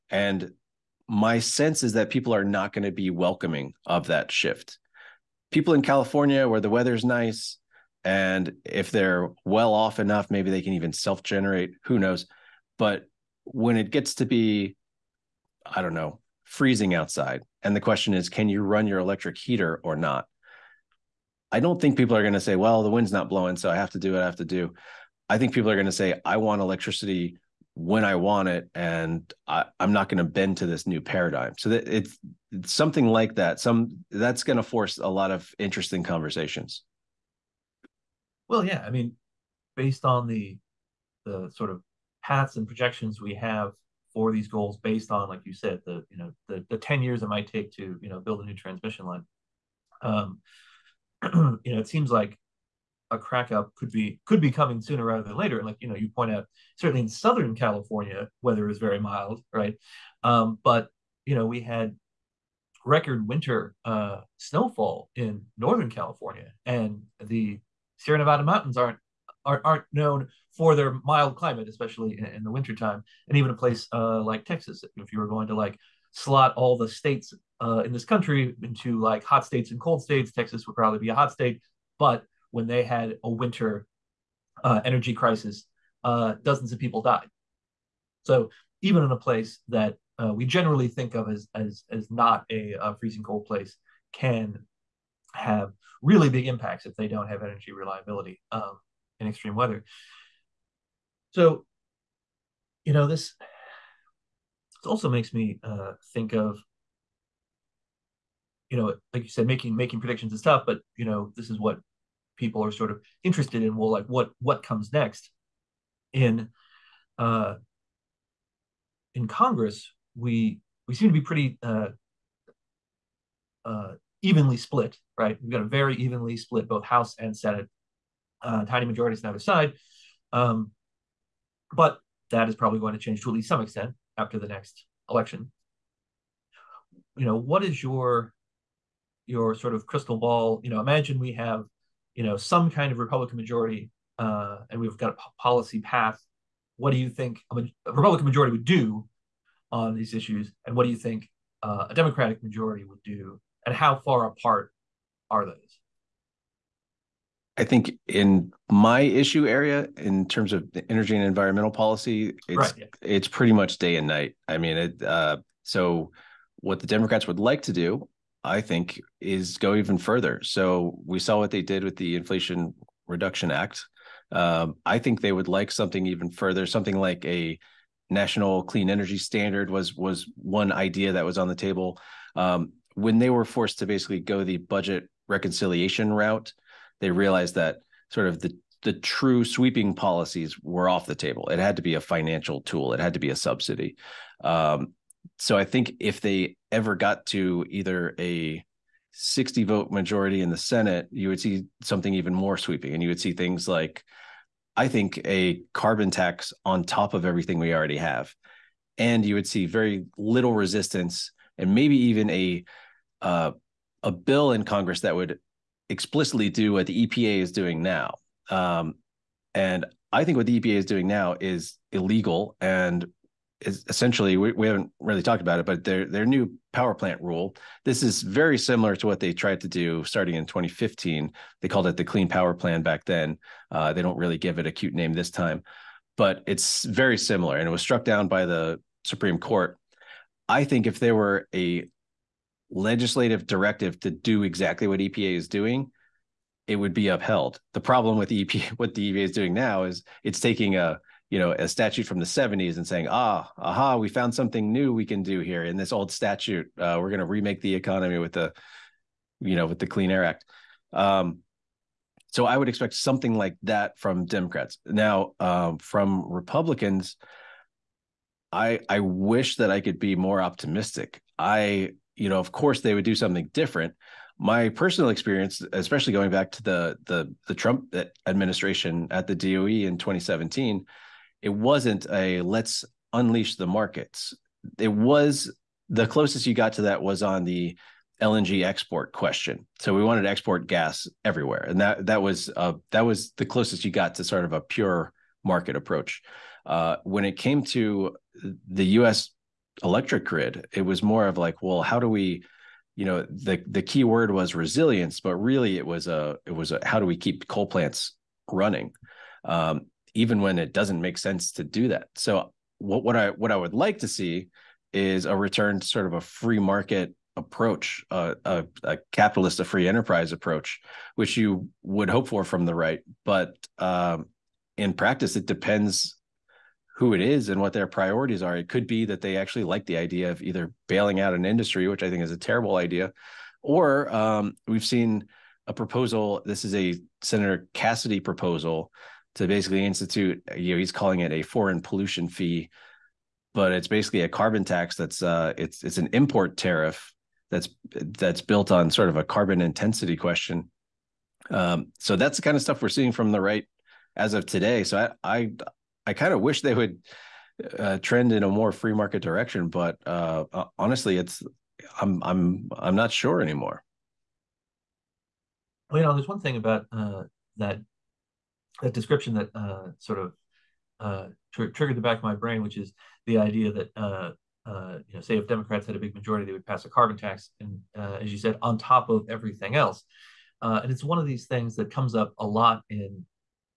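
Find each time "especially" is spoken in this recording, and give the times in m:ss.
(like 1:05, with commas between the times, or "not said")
1:11, 4:35.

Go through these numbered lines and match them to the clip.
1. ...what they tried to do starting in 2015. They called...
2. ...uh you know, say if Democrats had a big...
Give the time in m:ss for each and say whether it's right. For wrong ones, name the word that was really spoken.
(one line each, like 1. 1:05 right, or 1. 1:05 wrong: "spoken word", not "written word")
1. 3:49 right
2. 6:14 right.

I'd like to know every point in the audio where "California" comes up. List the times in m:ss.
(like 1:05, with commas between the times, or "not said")
0:05, 0:57, 1:05.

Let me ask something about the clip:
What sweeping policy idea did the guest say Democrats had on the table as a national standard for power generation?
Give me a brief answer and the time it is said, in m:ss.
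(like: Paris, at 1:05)
national clean energy standard, at 2:58.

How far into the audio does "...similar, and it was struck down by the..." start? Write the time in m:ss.
3:57.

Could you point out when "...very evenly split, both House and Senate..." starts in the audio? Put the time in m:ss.
2:05.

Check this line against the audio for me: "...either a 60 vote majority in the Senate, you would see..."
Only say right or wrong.
right.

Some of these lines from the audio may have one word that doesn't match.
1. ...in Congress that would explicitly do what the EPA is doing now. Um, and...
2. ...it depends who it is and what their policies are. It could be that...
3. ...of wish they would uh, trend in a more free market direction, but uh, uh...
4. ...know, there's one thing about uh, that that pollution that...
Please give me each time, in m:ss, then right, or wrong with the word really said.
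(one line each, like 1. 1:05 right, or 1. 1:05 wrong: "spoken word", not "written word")
1. 3:34 right
2. 5:25 wrong: "priorities", not "policies"
3. 5:56 right
4. 6:06 wrong: "description", not "pollution".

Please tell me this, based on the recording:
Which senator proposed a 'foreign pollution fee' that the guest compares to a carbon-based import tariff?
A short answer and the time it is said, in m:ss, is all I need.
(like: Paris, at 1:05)
Senator Cassidy, at 5:37.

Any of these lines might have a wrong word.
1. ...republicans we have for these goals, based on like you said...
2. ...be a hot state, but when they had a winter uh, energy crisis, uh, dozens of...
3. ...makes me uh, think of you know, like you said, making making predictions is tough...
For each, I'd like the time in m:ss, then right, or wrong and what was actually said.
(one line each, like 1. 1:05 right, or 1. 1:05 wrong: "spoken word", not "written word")
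1. 0:42 wrong: "projections", not "republicans"
2. 1:20 right
3. 1:45 right.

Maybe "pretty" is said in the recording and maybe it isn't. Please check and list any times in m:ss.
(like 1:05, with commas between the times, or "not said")
2:01, 2:43.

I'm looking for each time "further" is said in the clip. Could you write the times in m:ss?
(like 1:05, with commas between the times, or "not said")
2:49, 2:56.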